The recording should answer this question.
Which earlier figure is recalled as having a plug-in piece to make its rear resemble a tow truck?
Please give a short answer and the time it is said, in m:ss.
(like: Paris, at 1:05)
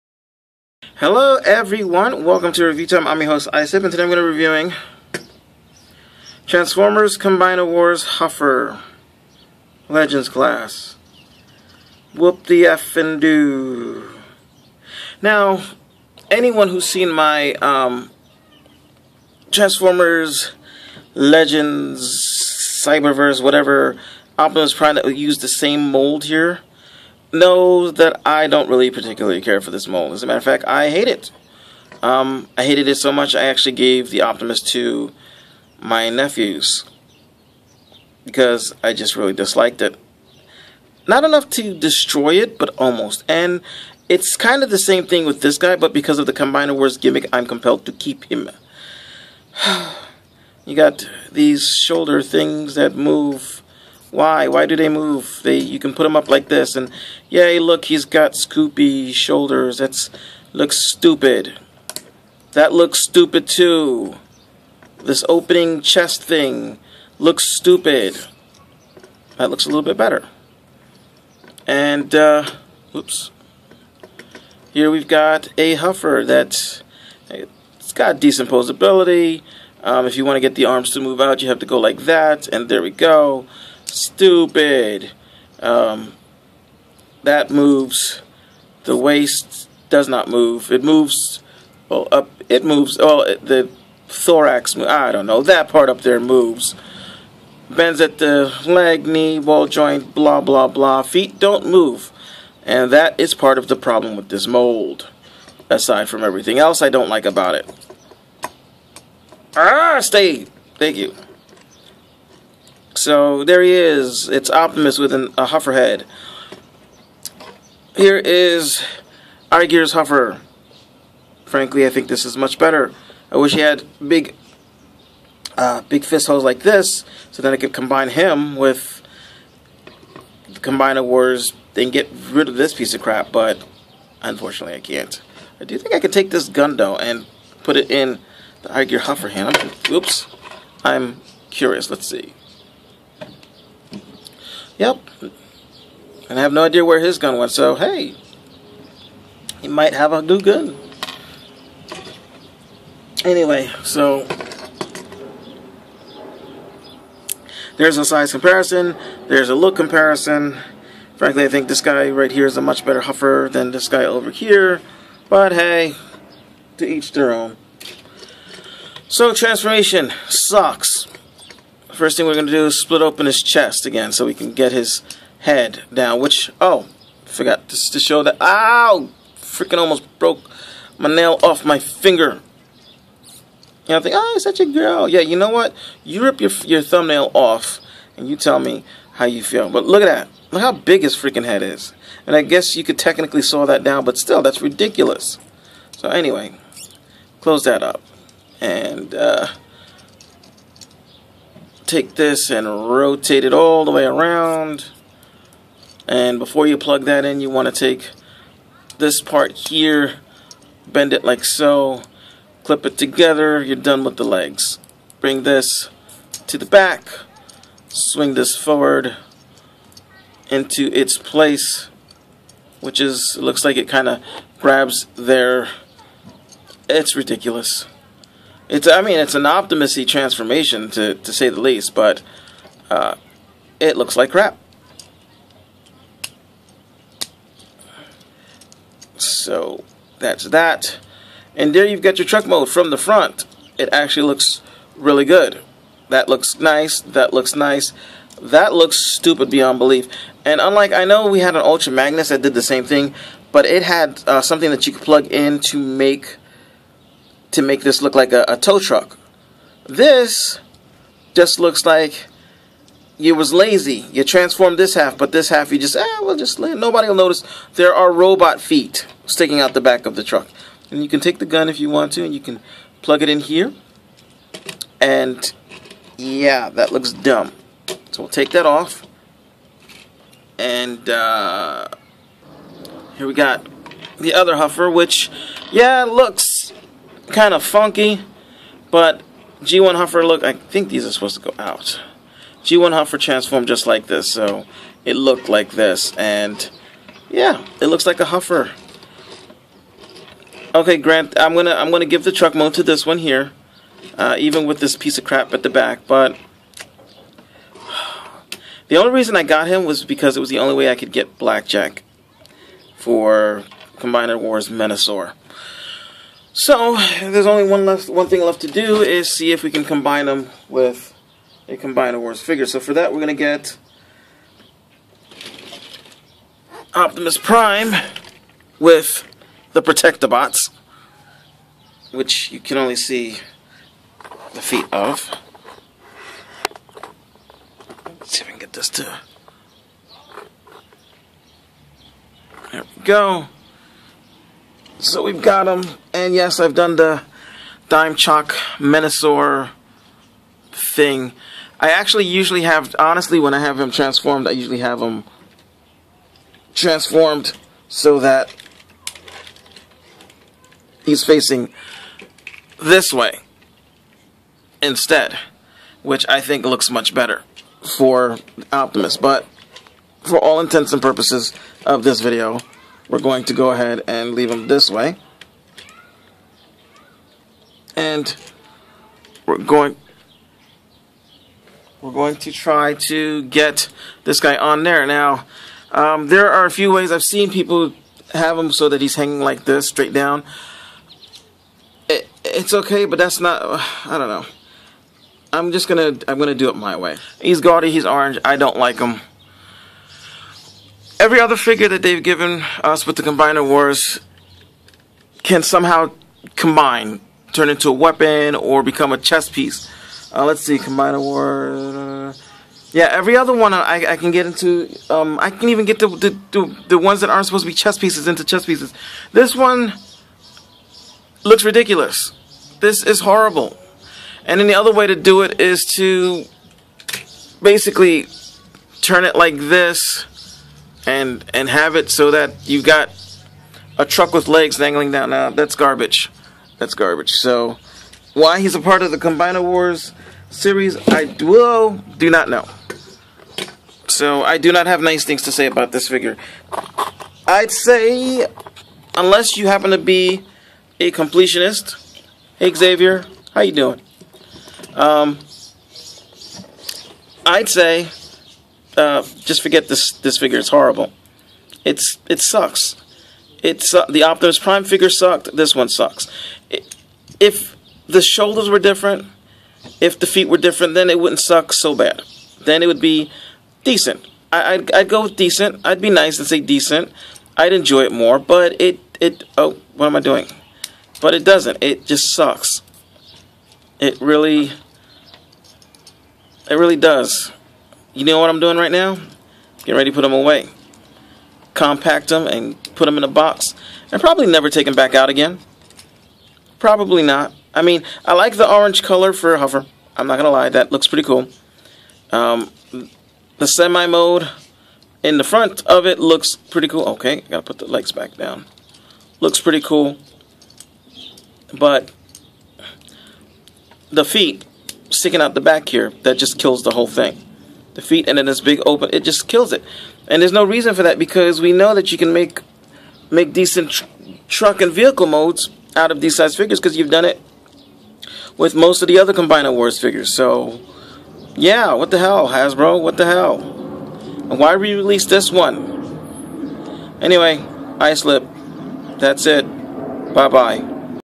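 Ultra Magnus, at 4:11.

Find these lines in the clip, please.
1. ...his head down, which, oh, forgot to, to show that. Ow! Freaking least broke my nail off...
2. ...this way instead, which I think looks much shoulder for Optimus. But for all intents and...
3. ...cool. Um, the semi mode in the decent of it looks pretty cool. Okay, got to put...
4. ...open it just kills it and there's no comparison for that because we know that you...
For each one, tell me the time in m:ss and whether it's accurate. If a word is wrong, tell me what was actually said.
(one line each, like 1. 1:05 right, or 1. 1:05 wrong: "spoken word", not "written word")
1. 2:54 wrong: "almost", not "least"
2. 6:02 wrong: "better", not "shoulder"
3. 8:21 wrong: "front", not "decent"
4. 8:38 wrong: "reason", not "comparison".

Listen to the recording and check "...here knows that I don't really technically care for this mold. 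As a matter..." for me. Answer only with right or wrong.
wrong.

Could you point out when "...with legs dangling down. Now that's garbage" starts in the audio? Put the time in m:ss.
7:14.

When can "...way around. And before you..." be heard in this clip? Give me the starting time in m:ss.
3:23.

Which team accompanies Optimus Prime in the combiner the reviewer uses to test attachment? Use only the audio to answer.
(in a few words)
Protectobots.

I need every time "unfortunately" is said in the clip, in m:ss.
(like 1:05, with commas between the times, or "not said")
2:14.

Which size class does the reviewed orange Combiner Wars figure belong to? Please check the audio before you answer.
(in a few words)
Legends Class.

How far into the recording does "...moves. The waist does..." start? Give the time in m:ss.
1:27.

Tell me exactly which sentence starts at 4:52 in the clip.
G1 Huffer transformed just like this, so it looked like this, and yeah, it looks like a Huffer.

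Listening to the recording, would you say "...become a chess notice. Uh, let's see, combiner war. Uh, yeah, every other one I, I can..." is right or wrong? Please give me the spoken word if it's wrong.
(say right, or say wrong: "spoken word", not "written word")
wrong: "piece", not "notice".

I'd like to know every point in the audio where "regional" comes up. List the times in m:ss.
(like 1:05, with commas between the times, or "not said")
not said.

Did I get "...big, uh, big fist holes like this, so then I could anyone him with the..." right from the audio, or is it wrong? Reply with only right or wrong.
wrong.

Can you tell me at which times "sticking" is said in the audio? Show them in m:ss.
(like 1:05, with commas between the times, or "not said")
4:29, 8:35.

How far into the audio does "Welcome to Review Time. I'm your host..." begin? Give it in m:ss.
0:02.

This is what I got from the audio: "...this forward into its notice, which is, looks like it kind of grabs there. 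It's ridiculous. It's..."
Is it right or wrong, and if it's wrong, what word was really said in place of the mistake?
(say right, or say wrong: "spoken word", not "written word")
wrong: "place", not "notice".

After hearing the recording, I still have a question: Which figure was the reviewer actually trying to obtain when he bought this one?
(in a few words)
Blackjack.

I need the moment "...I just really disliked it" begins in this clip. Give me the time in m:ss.
0:38.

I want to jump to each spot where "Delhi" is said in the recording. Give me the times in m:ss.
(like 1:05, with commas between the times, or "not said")
not said.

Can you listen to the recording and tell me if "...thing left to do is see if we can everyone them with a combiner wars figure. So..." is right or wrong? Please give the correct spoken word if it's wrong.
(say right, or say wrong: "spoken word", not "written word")
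wrong: "combine", not "everyone".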